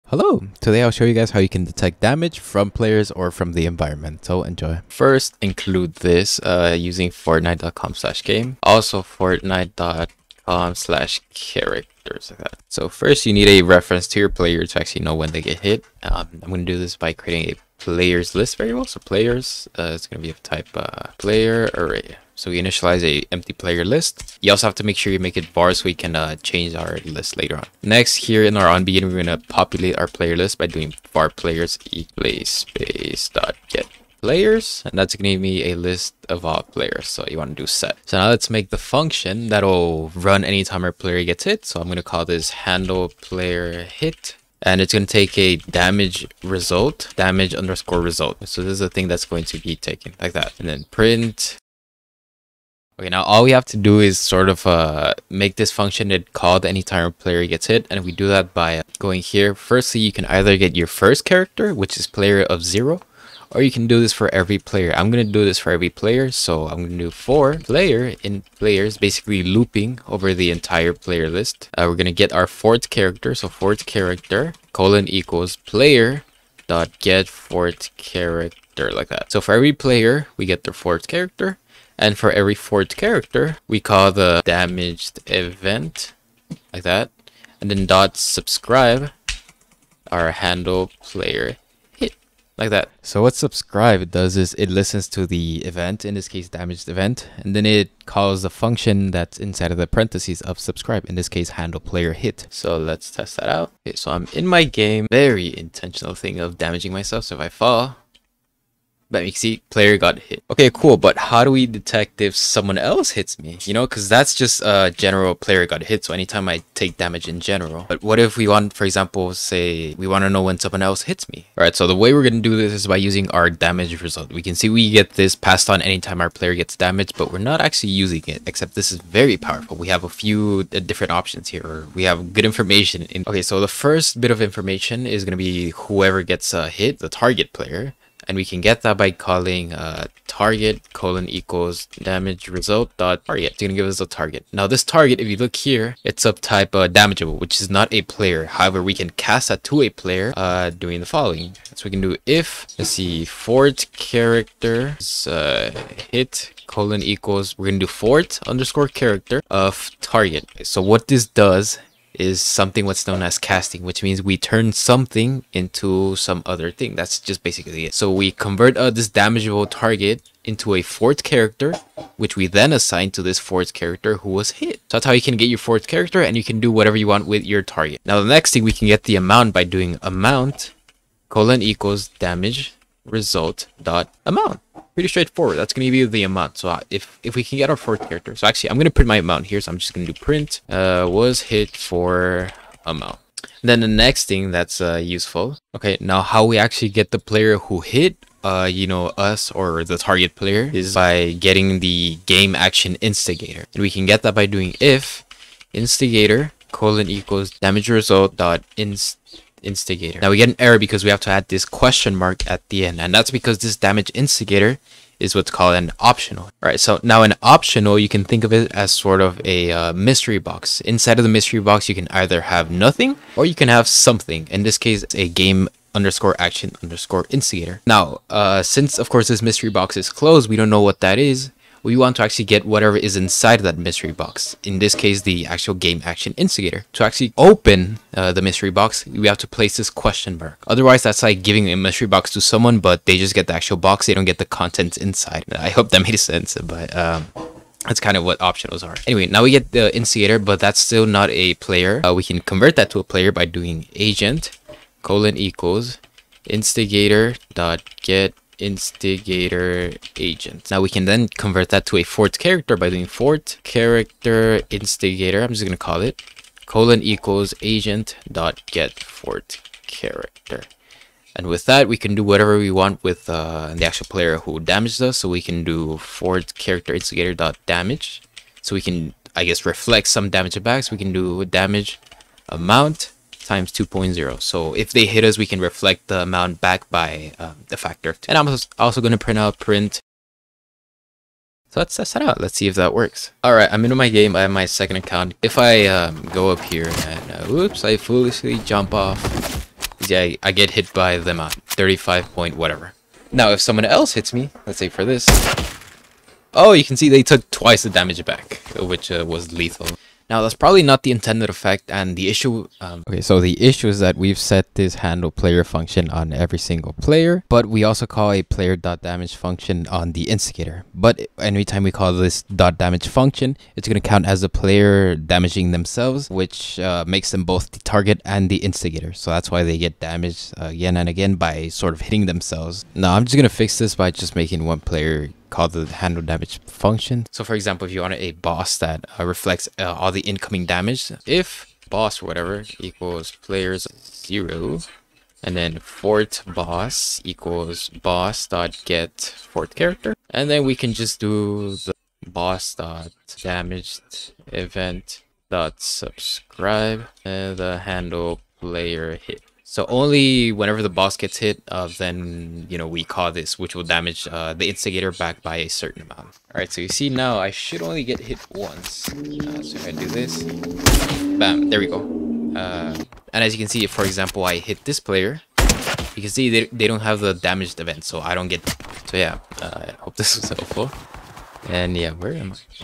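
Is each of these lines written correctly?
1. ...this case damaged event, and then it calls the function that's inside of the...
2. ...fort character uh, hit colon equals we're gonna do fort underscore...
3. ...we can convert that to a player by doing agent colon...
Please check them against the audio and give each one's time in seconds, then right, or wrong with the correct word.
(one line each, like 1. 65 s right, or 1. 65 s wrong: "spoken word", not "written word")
1. 96 s right
2. 153 s right
3. 252 s right.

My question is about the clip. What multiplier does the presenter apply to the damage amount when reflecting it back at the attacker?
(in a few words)
2.0.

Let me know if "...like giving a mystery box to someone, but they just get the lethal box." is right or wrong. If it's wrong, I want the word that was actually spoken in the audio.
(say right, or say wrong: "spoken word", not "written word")
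wrong: "actual", not "lethal".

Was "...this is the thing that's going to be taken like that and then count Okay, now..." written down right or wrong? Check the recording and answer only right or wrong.
wrong.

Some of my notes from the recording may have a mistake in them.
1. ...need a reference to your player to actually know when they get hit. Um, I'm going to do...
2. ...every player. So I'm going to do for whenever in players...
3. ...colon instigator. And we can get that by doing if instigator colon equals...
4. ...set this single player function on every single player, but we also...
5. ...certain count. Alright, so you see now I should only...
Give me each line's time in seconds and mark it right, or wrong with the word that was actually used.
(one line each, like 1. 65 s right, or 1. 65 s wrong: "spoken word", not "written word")
1. 13 s right
2. 65 s wrong: "player", not "whenever"
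3. 202 s wrong: "action", not "colon"
4. 314 s wrong: "handle", not "single"
5. 365 s wrong: "amount", not "count".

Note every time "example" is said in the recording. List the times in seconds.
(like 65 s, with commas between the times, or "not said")
118 s, 337 s, 374 s.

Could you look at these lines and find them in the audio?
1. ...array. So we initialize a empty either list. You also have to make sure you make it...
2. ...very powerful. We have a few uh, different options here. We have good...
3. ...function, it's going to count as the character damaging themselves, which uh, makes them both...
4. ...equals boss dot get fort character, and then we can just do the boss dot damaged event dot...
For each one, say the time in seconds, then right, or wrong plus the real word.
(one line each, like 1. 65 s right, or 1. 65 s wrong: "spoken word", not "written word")
1. 21 s wrong: "player", not "either"
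2. 129 s right
3. 323 s wrong: "player", not "character"
4. 347 s right.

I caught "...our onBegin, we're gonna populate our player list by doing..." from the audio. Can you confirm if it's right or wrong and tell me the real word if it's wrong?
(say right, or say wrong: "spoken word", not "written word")
right.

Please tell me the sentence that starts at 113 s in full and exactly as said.
You know, because that's just a uh, general player got hit.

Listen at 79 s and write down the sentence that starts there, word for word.
So for every player, we get their fort character.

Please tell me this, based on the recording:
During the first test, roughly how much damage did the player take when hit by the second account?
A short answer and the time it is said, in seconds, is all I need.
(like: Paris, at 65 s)
35, at 301 s.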